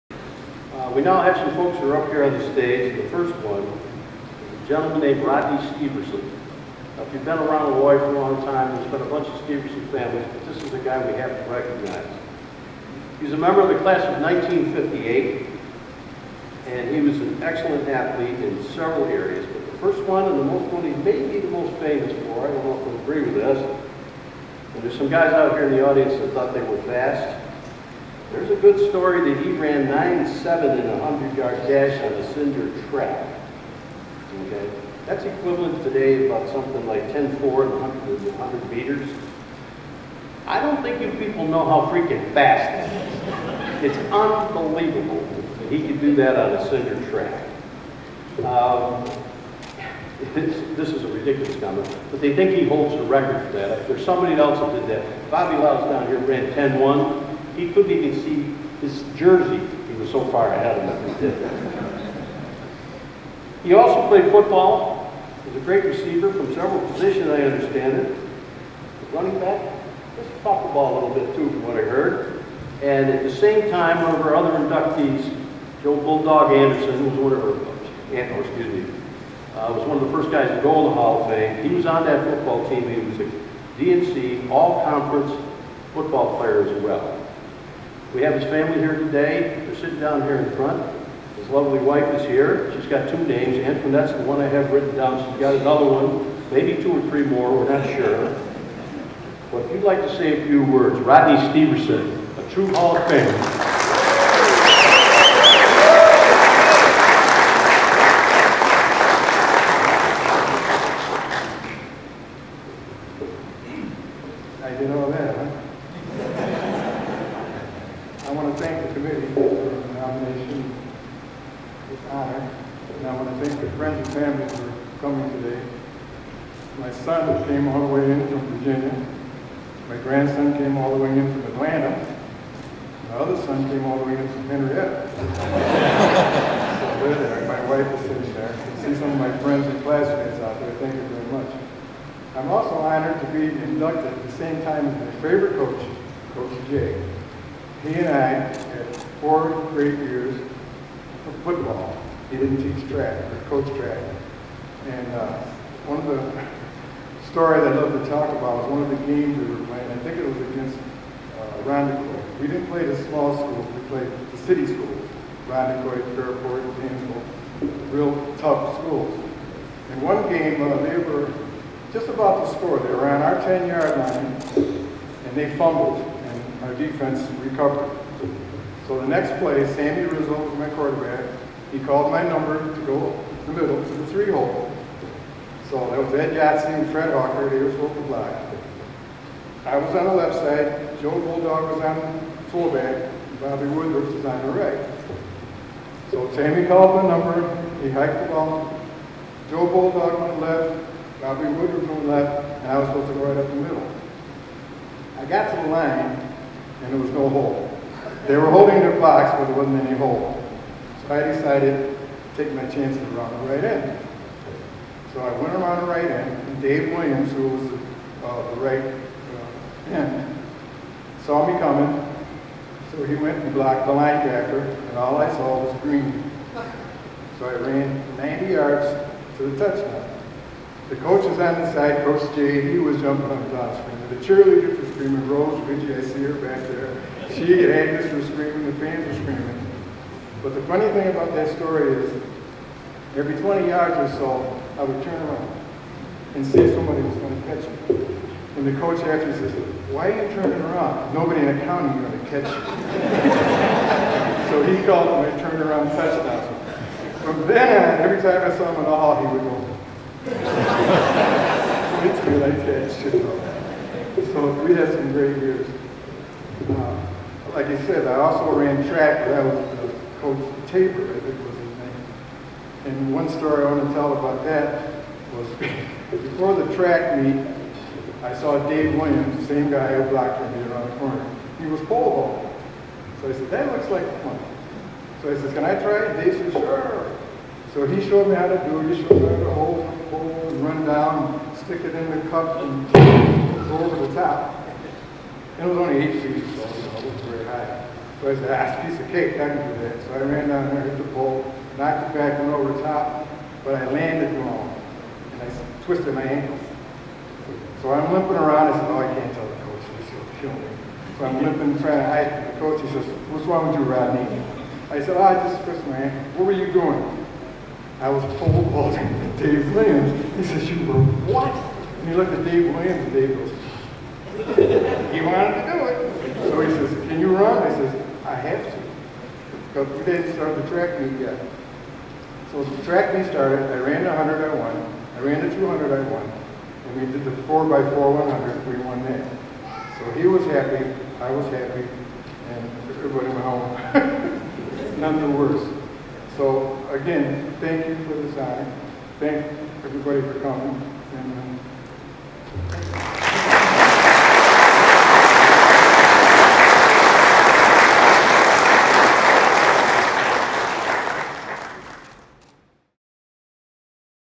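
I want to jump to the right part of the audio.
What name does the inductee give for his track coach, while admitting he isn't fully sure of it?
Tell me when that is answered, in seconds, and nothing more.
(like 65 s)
270 s.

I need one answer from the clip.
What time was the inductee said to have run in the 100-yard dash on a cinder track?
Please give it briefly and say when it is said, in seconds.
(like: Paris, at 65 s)
9.7, at 29 s.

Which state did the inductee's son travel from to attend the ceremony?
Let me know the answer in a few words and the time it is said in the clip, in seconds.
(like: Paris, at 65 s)
Virginia, at 128 s.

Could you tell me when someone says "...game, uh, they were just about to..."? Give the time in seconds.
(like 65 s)
170 s.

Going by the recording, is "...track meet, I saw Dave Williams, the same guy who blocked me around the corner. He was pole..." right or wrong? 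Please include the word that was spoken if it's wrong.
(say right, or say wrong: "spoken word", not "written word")
right.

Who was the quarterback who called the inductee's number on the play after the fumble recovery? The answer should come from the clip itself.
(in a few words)
Sammy Rizzo.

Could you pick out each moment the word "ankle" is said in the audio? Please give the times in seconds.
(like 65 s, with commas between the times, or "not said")
306 s, 315 s.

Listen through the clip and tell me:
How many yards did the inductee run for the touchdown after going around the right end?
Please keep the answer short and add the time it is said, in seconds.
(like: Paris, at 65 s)
90, at 228 s.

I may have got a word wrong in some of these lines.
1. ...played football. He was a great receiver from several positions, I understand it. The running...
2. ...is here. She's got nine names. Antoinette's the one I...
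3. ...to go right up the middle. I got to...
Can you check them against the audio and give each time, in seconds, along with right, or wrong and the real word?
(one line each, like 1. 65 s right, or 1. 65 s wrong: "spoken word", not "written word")
1. 64 s right
2. 92 s wrong: "two", not "nine"
3. 203 s right.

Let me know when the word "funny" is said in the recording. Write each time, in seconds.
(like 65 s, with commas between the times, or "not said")
240 s.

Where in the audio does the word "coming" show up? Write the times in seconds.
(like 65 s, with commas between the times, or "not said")
125 s, 221 s, 350 s.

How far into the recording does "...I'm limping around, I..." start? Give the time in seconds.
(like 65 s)
307 s.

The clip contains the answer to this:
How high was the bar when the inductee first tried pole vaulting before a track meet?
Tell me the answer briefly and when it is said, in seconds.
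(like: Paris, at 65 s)
8 feet, at 296 s.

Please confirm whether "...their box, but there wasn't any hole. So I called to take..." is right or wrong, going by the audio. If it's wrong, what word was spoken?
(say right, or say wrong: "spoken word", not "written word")
wrong: "decided", not "called".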